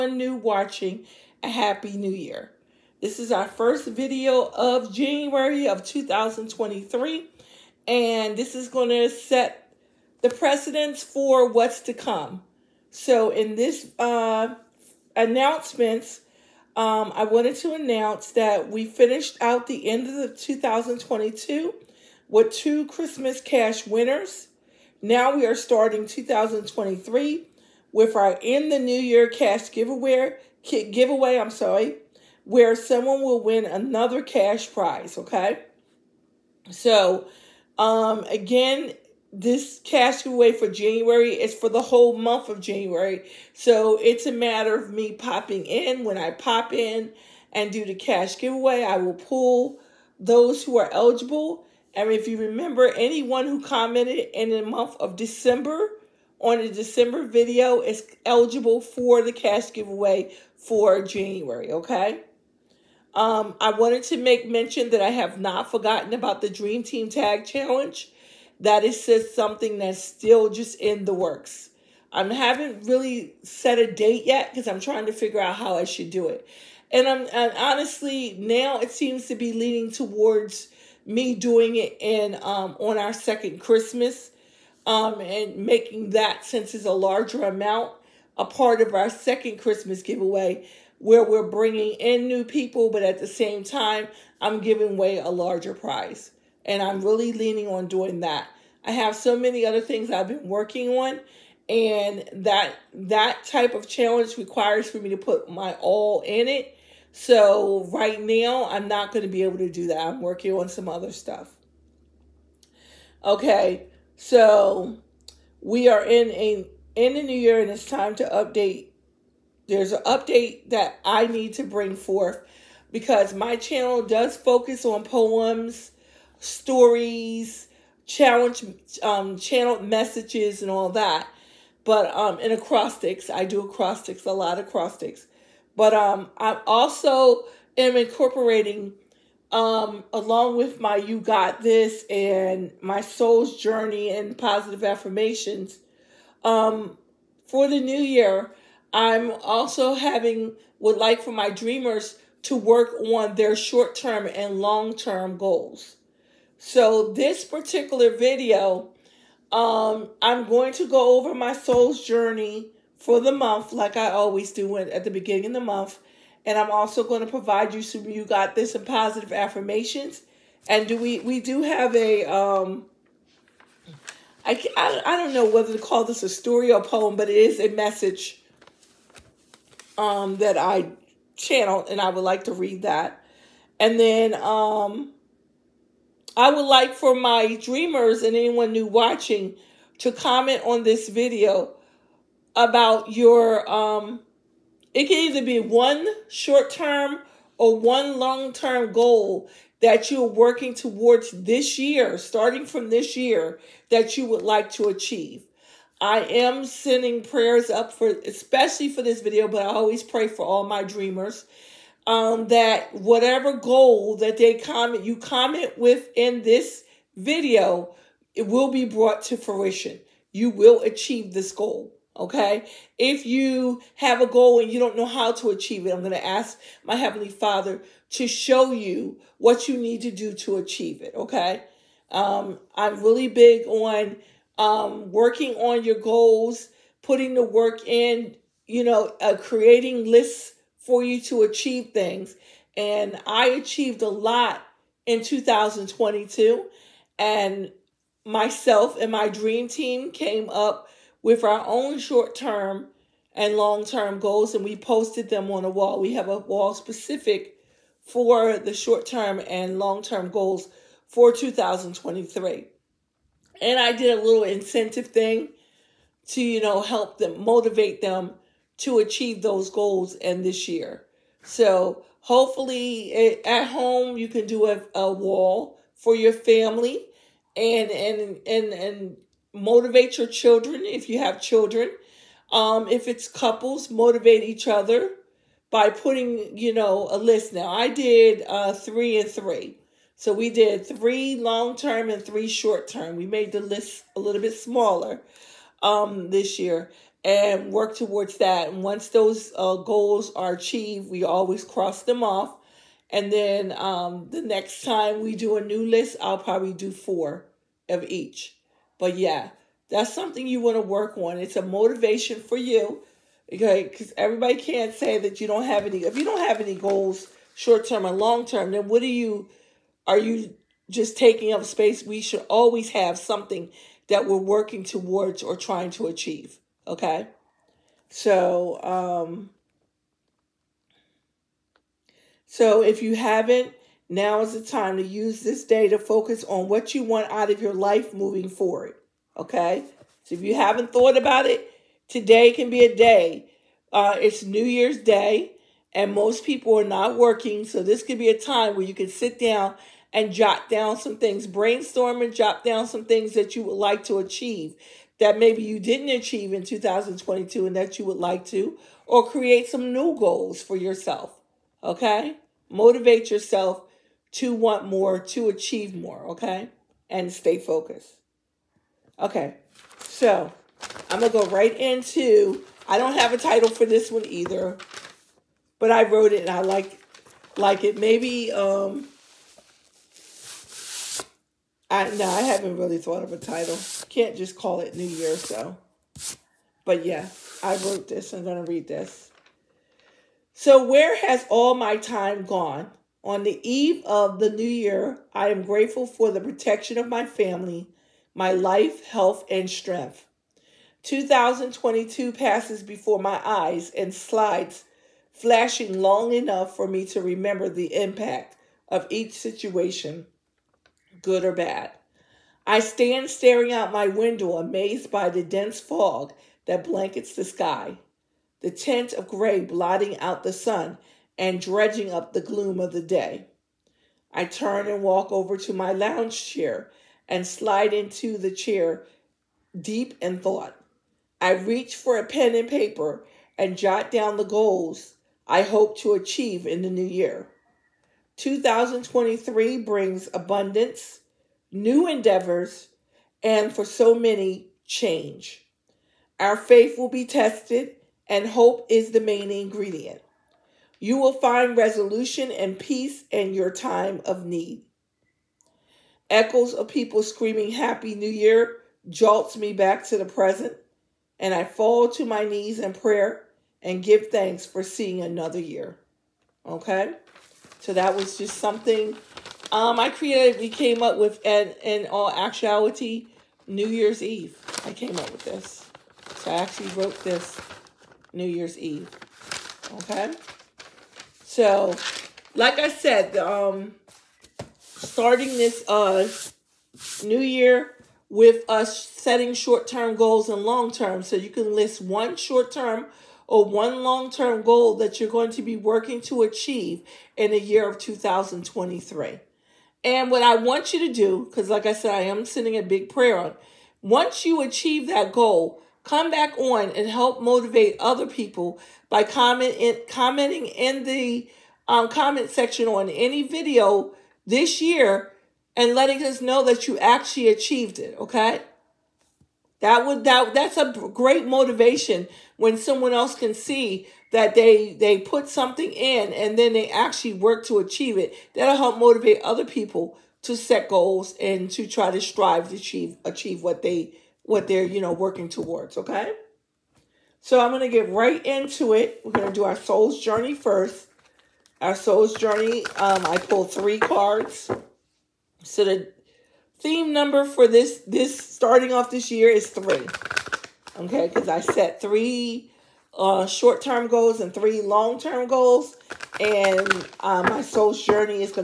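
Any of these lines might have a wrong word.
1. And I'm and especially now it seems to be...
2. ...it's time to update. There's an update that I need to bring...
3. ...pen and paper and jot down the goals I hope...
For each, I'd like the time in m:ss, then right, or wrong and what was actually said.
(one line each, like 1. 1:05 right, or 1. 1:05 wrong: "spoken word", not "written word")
1. 1:16 wrong: "honestly", not "especially"
2. 1:57 right
3. 7:12 right.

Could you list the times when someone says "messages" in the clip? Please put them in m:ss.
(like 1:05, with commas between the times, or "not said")
2:09, 2:57.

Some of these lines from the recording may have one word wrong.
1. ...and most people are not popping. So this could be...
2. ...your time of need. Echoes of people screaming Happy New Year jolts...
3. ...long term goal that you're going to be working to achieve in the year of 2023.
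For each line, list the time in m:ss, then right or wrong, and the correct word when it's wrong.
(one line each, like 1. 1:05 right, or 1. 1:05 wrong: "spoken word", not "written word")
1. 5:45 wrong: "working", not "popping"
2. 7:33 right
3. 8:14 right.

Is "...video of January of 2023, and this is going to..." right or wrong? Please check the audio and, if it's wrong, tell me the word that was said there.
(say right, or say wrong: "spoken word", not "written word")
right.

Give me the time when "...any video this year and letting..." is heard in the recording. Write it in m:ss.
8:33.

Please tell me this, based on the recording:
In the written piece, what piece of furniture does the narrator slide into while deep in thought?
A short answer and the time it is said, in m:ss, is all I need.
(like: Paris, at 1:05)
Lounge chair, at 7:05.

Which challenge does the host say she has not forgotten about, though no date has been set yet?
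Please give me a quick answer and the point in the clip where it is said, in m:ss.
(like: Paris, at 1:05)
Dream Team Tag Challenge, at 1:06.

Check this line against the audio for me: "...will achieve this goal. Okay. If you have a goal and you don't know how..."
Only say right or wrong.
right.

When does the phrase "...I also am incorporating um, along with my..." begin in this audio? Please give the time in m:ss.
2:16.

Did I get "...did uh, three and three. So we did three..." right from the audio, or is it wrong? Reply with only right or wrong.
right.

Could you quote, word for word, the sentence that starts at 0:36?
So um again, this cash giveaway for January is for the whole month of January.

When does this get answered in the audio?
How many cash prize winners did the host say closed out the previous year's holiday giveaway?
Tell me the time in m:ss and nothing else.
0:22.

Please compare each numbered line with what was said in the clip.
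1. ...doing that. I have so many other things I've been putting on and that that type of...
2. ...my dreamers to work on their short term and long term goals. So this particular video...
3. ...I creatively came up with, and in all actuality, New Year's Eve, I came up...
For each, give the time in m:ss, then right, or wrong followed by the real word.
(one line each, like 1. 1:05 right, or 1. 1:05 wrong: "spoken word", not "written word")
1. 1:37 wrong: "working", not "putting"
2. 2:31 right
3. 7:49 right.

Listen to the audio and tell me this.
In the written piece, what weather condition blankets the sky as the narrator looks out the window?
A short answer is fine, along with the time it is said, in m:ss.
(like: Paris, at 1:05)
Dense fog, at 6:55.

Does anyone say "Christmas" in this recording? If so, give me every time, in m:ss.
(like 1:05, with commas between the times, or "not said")
0:22, 1:23, 1:29.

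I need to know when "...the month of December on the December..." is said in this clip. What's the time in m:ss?
0:54.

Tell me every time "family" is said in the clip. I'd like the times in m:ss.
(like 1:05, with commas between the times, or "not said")
4:36, 6:37.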